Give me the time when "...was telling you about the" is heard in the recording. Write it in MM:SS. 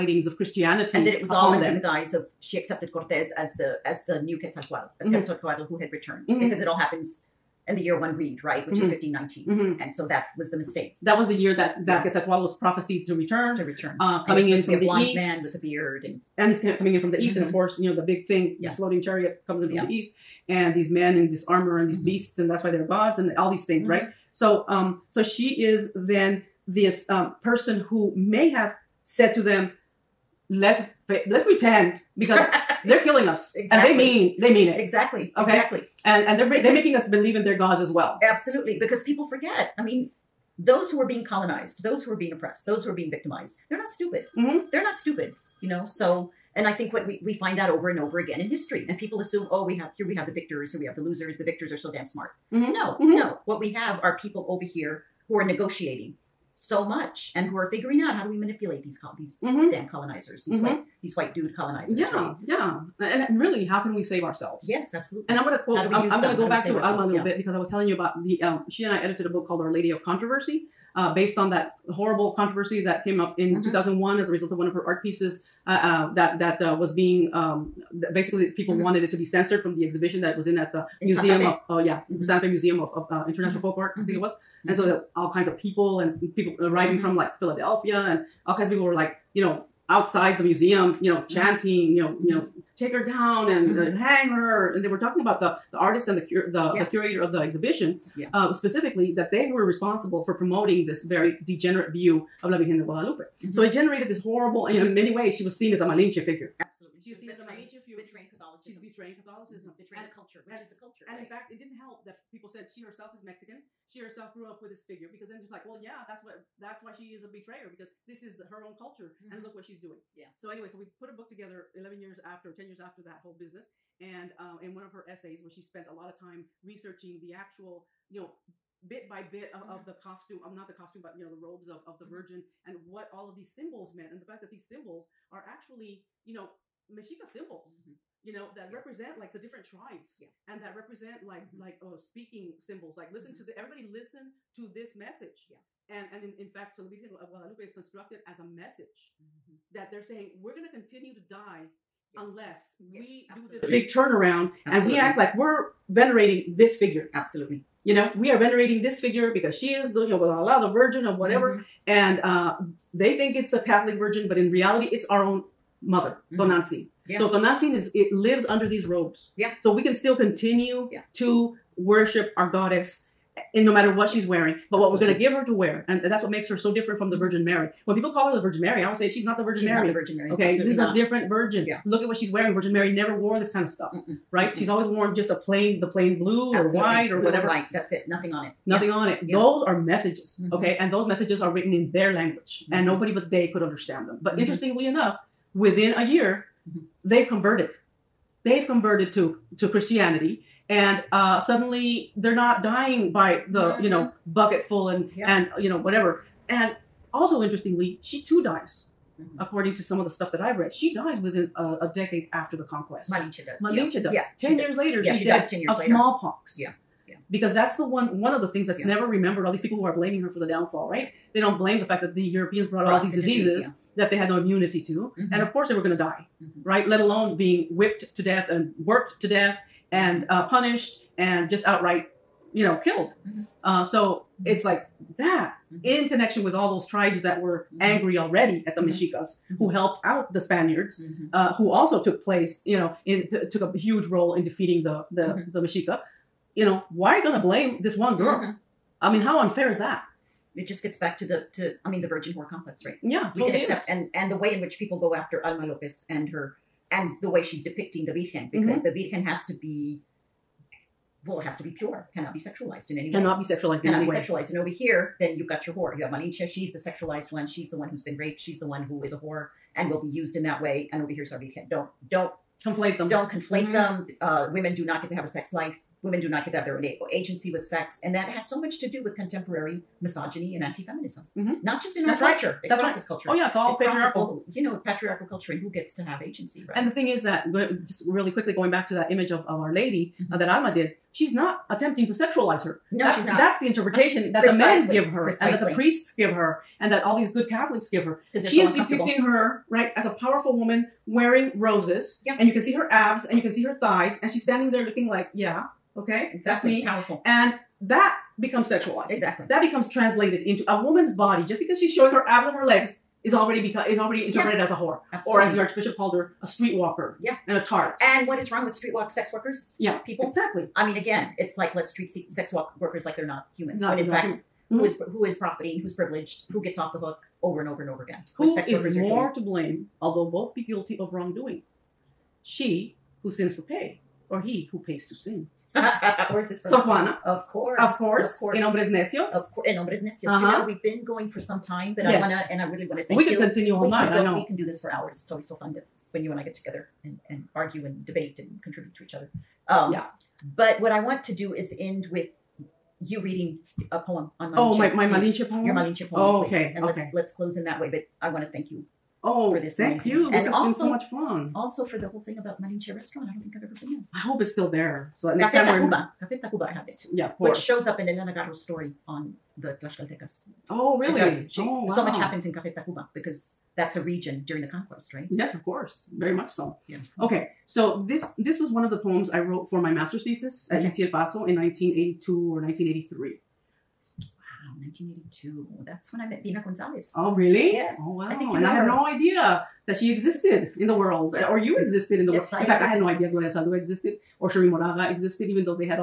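01:07.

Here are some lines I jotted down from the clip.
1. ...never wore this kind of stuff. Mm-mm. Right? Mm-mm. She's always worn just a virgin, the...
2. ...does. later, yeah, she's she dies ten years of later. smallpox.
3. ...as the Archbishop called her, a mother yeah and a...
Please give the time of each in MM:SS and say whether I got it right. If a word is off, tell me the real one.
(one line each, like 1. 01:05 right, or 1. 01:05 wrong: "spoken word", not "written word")
1. 03:02 wrong: "plain", not "virgin"
2. 03:34 right
3. 05:15 wrong: "streetwalker", not "mother".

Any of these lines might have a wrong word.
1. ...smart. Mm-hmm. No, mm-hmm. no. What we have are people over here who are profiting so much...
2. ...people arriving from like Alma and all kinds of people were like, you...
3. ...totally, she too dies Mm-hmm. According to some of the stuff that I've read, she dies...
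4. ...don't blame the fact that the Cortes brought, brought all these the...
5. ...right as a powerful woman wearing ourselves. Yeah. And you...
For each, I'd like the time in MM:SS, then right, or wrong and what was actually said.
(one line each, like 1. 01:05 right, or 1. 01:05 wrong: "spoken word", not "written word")
1. 00:52 wrong: "negotiating", not "profiting"
2. 01:26 wrong: "Philadelphia", not "Alma"
3. 03:27 wrong: "interestingly", not "totally"
4. 03:41 wrong: "Europeans", not "Cortes"
5. 04:59 wrong: "roses", not "ourselves".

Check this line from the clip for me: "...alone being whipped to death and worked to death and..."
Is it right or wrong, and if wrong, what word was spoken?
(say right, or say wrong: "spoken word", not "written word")
right.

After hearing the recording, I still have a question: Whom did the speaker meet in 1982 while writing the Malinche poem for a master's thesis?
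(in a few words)
Deena Gonzalez.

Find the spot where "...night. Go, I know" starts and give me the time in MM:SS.
05:43.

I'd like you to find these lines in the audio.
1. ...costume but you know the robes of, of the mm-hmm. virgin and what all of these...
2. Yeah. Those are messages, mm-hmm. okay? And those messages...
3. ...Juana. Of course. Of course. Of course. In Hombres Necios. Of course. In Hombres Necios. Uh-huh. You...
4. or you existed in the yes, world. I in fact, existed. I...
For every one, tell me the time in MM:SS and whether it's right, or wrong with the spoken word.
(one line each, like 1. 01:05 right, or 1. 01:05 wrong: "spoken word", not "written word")
1. 02:10 right
2. 03:09 right
3. 05:36 right
4. 06:31 right.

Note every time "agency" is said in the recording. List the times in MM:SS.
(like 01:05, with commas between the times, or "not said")
04:37, 04:46.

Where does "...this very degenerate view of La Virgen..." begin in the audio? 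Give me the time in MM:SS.
01:40.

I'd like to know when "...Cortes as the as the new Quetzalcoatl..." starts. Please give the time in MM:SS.
00:02.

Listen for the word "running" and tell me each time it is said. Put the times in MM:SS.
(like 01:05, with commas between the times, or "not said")
not said.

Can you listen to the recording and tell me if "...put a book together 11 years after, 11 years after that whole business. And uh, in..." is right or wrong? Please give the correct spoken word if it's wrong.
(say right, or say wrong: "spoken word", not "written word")
wrong: "10", not "11".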